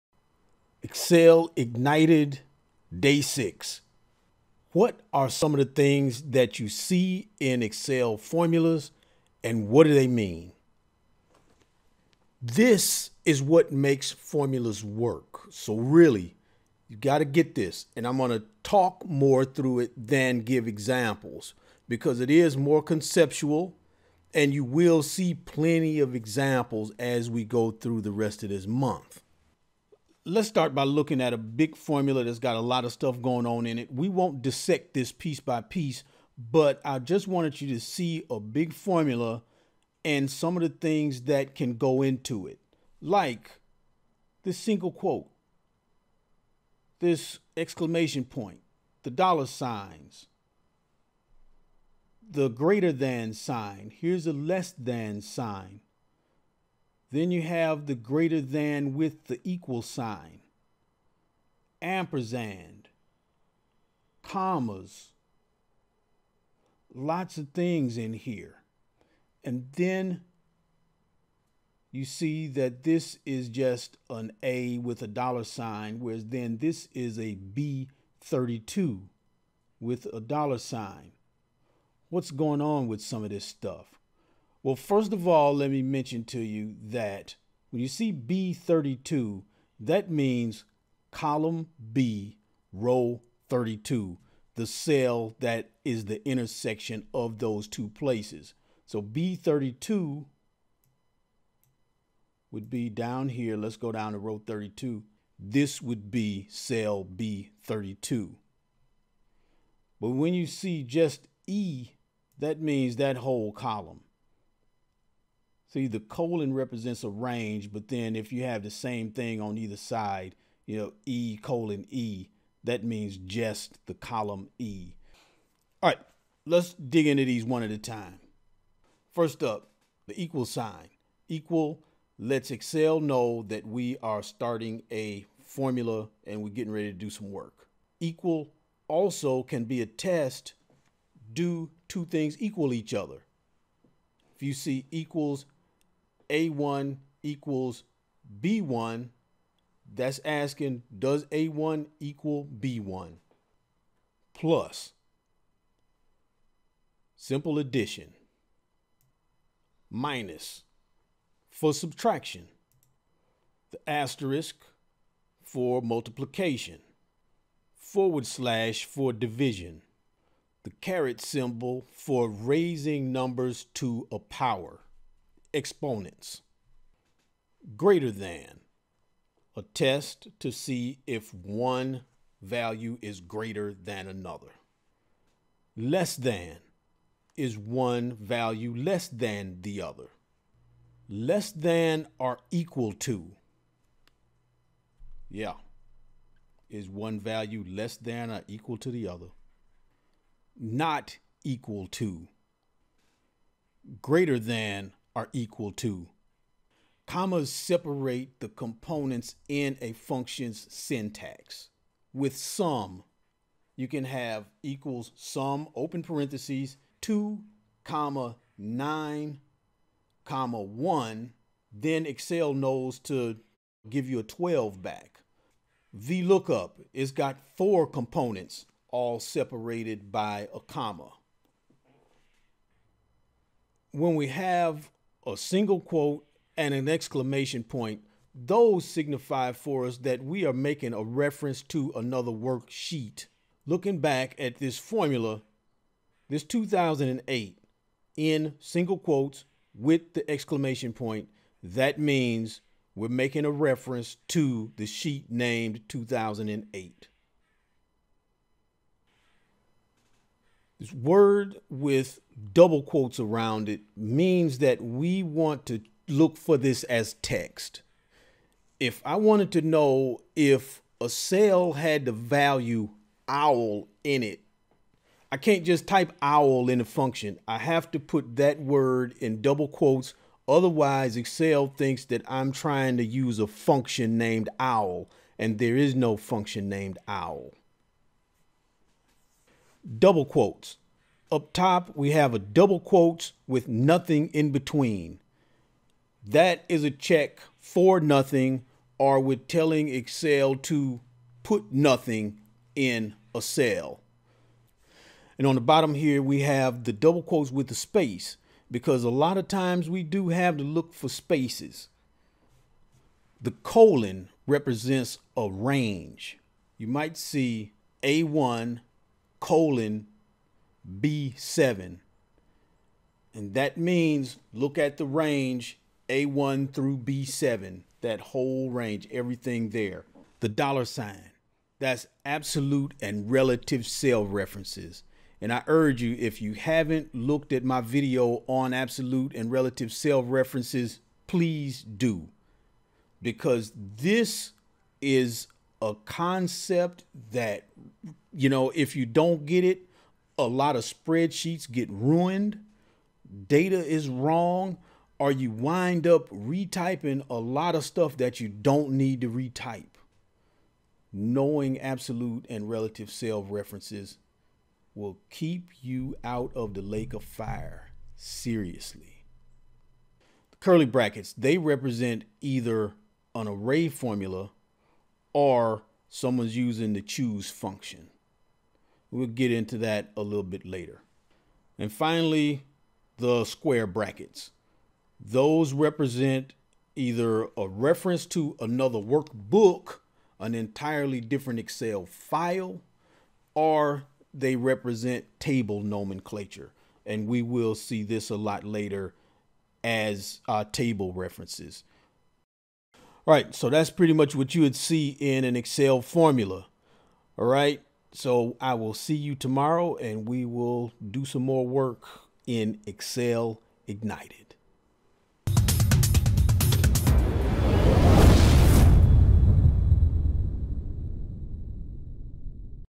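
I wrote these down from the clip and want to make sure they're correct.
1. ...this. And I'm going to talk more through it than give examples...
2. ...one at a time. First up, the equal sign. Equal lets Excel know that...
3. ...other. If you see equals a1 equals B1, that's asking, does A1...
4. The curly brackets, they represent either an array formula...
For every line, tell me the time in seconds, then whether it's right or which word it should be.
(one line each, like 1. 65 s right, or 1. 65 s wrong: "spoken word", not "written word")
1. 17 s right
2. 127 s right
3. 142 s right
4. 370 s right.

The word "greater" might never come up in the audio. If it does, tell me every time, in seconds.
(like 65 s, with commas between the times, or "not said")
52 s, 57 s, 177 s, 183 s, 204 s.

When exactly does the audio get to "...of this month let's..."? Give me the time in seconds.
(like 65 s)
28 s.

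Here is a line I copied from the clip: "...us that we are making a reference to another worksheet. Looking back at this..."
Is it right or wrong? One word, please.
right.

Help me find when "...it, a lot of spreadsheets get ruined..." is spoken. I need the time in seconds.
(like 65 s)
349 s.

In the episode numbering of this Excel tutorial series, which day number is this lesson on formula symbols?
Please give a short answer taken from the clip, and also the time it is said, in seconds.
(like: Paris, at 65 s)
6, at 2 s.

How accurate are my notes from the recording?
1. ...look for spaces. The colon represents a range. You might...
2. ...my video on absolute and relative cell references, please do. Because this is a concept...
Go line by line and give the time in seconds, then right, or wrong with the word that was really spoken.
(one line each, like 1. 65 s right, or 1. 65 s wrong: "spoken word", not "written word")
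1. 310 s right
2. 337 s right.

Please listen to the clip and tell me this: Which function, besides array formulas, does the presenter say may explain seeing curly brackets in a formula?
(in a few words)
choose.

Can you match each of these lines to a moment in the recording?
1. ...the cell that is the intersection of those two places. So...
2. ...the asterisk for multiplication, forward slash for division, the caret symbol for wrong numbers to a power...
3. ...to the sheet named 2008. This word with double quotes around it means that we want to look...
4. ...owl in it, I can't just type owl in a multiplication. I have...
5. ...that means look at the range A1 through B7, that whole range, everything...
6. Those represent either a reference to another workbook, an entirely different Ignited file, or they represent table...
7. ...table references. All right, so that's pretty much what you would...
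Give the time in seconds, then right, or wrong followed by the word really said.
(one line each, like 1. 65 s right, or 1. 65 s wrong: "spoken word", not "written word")
1. 94 s right
2. 163 s wrong: "raising", not "wrong"
3. 254 s right
4. 273 s wrong: "function", not "multiplication"
5. 323 s right
6. 385 s wrong: "Excel", not "Ignited"
7. 400 s right.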